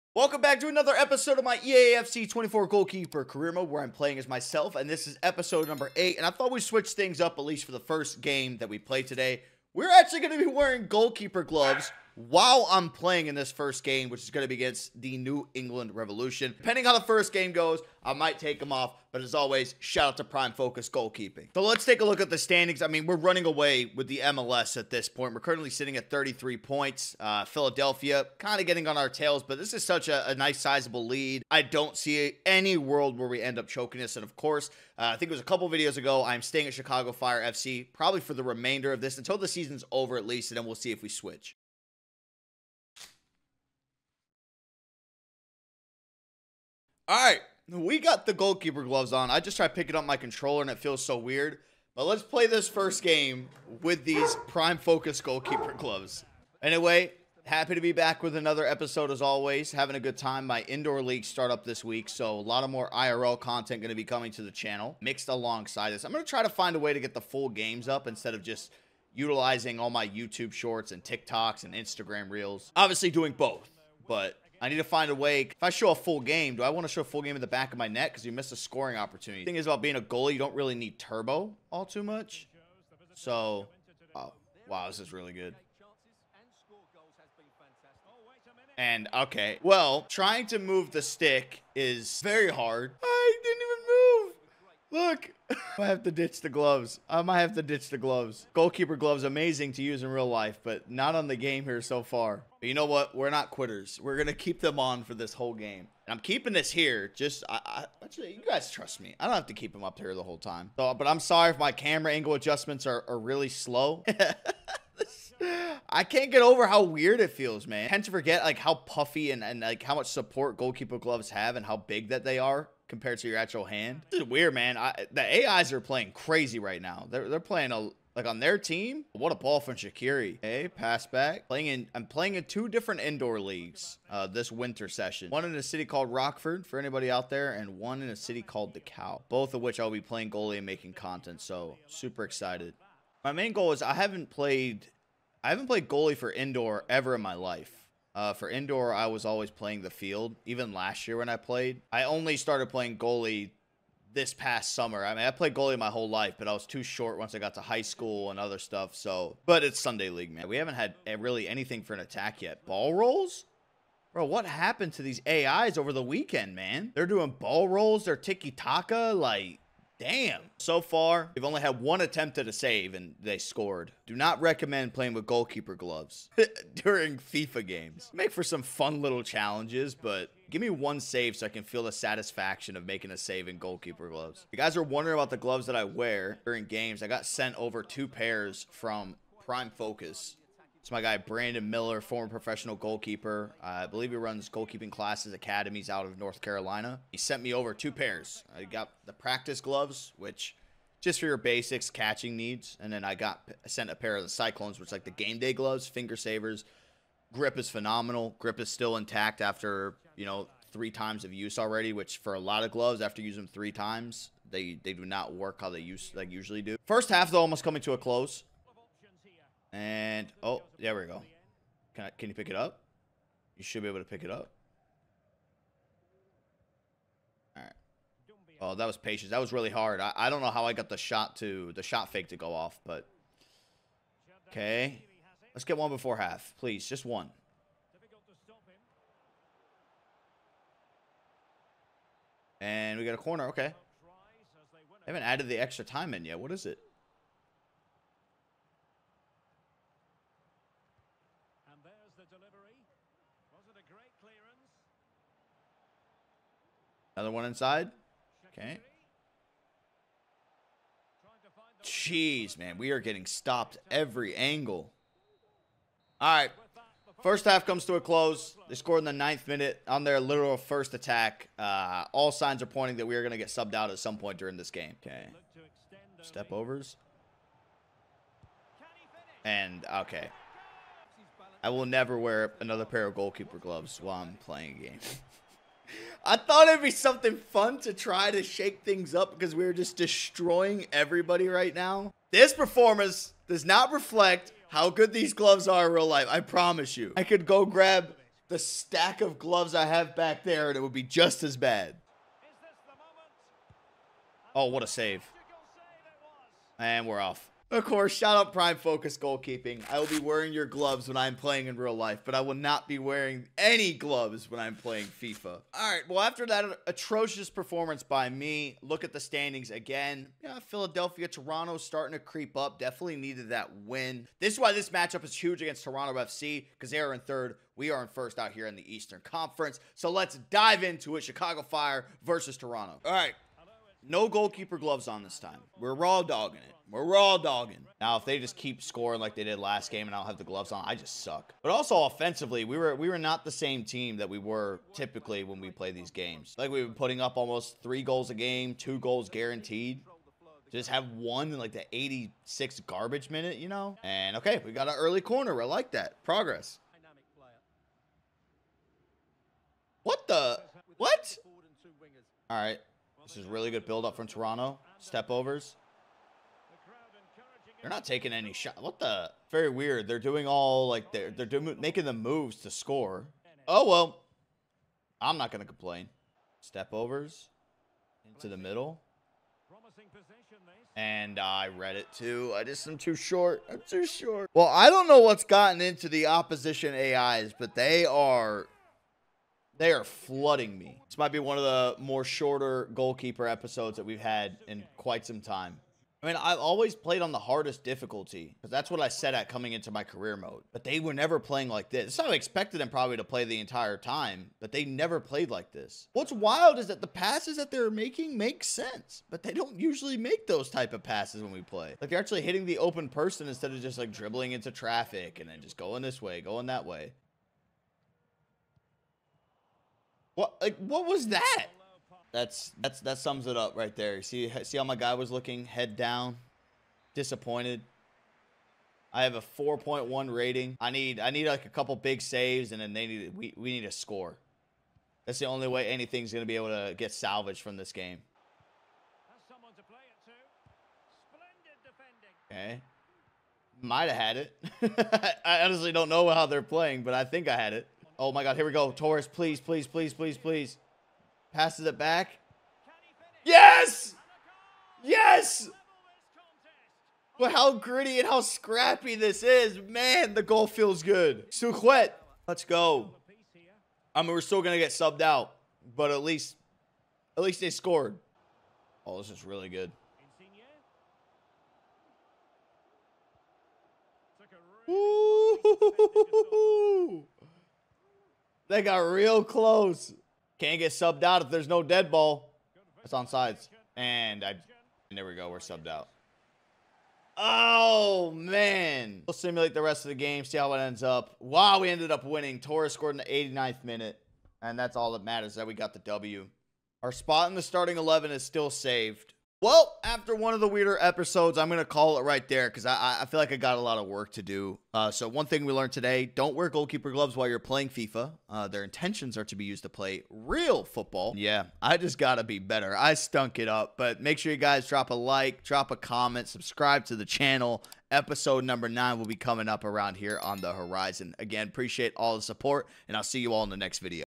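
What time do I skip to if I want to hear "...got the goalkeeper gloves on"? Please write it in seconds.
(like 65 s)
47 s.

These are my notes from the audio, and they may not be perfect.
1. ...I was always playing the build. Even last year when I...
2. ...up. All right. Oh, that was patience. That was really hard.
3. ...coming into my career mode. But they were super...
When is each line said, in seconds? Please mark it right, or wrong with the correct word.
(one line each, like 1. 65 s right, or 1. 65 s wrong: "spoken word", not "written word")
1. 148 s wrong: "field", not "build"
2. 224 s right
3. 399 s wrong: "never", not "super".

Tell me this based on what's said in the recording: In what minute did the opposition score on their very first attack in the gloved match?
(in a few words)
9th minute.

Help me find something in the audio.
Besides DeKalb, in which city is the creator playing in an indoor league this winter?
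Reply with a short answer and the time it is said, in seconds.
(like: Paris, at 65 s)
Rockford, at 136 s.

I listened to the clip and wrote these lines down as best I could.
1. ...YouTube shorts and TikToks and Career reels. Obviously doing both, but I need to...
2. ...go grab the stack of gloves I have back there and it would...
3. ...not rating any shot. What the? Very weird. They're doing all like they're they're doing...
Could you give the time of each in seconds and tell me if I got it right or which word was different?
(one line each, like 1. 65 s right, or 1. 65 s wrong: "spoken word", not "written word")
1. 70 s wrong: "Instagram", not "Career"
2. 297 s right
3. 367 s wrong: "taking", not "rating".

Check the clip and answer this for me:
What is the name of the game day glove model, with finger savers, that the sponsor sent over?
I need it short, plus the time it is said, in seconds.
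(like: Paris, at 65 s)
Cyclones, at 204 s.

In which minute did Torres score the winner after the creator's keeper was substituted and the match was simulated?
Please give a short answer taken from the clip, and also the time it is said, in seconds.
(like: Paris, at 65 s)
89th minute, at 493 s.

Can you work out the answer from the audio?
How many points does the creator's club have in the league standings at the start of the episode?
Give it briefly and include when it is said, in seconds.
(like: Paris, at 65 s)
33, at 26 s.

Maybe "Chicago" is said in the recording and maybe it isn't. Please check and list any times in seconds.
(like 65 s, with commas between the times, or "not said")
36 s, 331 s.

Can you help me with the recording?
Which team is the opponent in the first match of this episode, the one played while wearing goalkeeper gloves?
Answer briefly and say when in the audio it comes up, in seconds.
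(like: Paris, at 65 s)
New England Revolution, at 15 s.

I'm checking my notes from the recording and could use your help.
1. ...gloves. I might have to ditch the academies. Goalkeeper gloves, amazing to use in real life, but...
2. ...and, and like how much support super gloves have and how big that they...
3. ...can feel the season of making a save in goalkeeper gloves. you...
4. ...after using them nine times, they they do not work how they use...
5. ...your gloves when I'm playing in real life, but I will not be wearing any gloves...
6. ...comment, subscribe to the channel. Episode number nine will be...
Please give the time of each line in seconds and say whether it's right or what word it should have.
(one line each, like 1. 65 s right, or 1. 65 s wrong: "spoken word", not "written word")
1. 96 s wrong: "gloves", not "academies"
2. 119 s wrong: "goalkeeper", not "super"
3. 181 s wrong: "satisfaction", not "season"
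4. 213 s wrong: "three", not "nine"
5. 310 s right
6. 515 s right.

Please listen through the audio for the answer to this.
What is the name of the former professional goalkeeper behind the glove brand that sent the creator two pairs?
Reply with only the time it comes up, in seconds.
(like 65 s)
191 s.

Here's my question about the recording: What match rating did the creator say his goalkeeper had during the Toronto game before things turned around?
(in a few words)
4.1.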